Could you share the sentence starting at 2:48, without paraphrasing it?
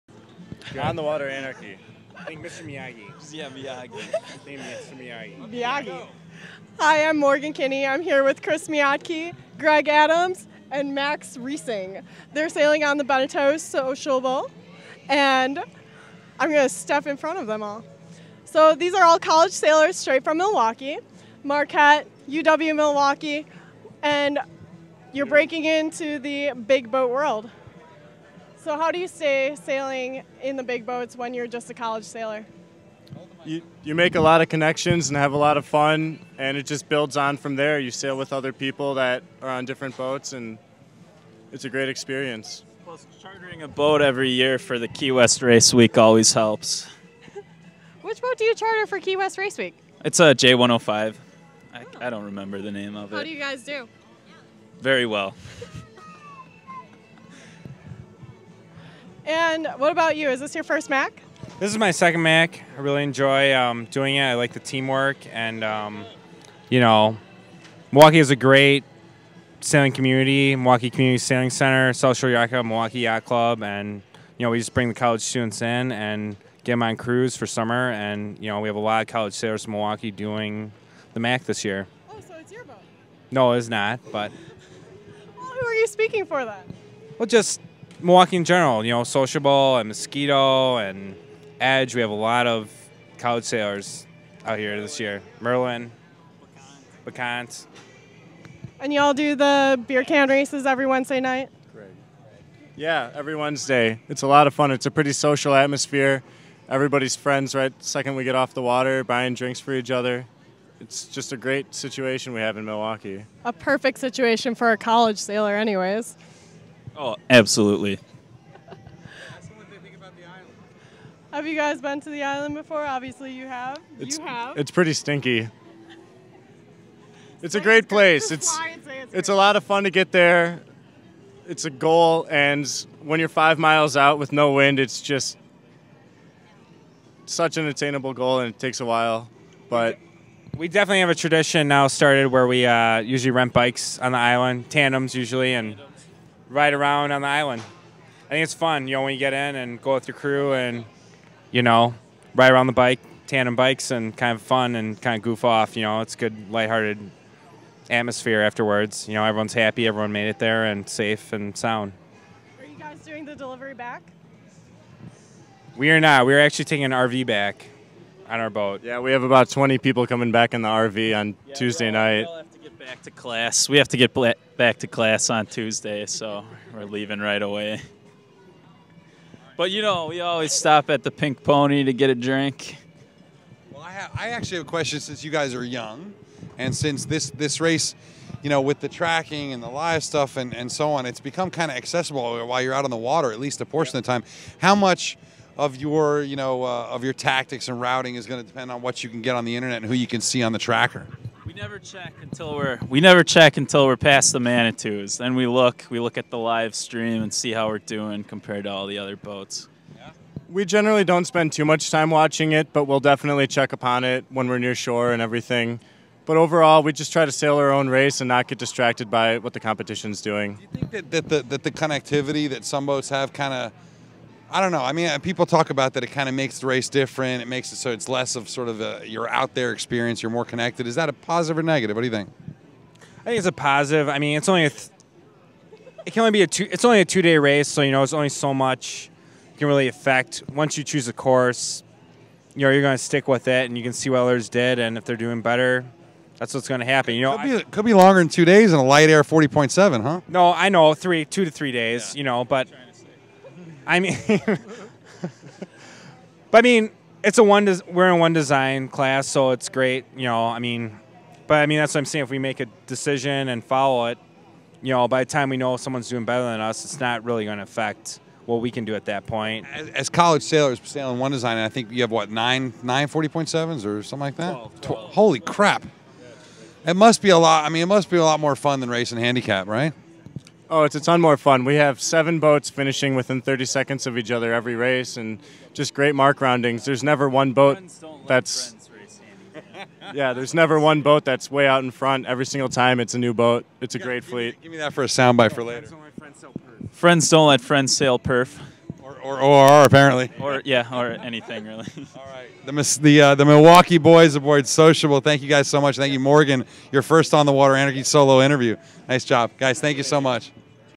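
Yeah, we have about 20 people coming back in the RV on yeah, Tuesday night back to class.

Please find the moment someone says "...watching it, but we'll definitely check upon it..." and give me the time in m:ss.
3:32.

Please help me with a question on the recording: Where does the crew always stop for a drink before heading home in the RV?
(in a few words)
Pink Pony.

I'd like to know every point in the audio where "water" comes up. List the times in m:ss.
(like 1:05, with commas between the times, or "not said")
0:01, 1:48, 3:12, 5:07.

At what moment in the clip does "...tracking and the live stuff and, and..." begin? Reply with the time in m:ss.
3:08.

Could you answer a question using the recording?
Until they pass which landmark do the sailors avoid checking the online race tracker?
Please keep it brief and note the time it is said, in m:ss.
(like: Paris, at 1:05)
The Manitous, at 3:24.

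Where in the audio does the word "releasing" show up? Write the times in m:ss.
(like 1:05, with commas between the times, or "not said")
not said.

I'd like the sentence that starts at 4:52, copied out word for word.
Every single time, it's a new boat.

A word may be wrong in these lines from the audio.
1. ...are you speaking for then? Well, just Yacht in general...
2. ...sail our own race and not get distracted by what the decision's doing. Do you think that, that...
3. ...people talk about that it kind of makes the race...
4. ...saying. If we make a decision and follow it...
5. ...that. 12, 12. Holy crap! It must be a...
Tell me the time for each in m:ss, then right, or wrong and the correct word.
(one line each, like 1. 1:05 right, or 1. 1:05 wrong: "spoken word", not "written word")
1. 1:25 wrong: "Milwaukee", not "Yacht"
2. 3:37 wrong: "competition", not "decision"
3. 3:45 right
4. 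4:22 right
5. 4:34 right.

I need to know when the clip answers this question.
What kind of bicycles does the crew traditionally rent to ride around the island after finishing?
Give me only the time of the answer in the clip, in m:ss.
2:24.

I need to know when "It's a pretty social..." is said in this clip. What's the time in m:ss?
1:44.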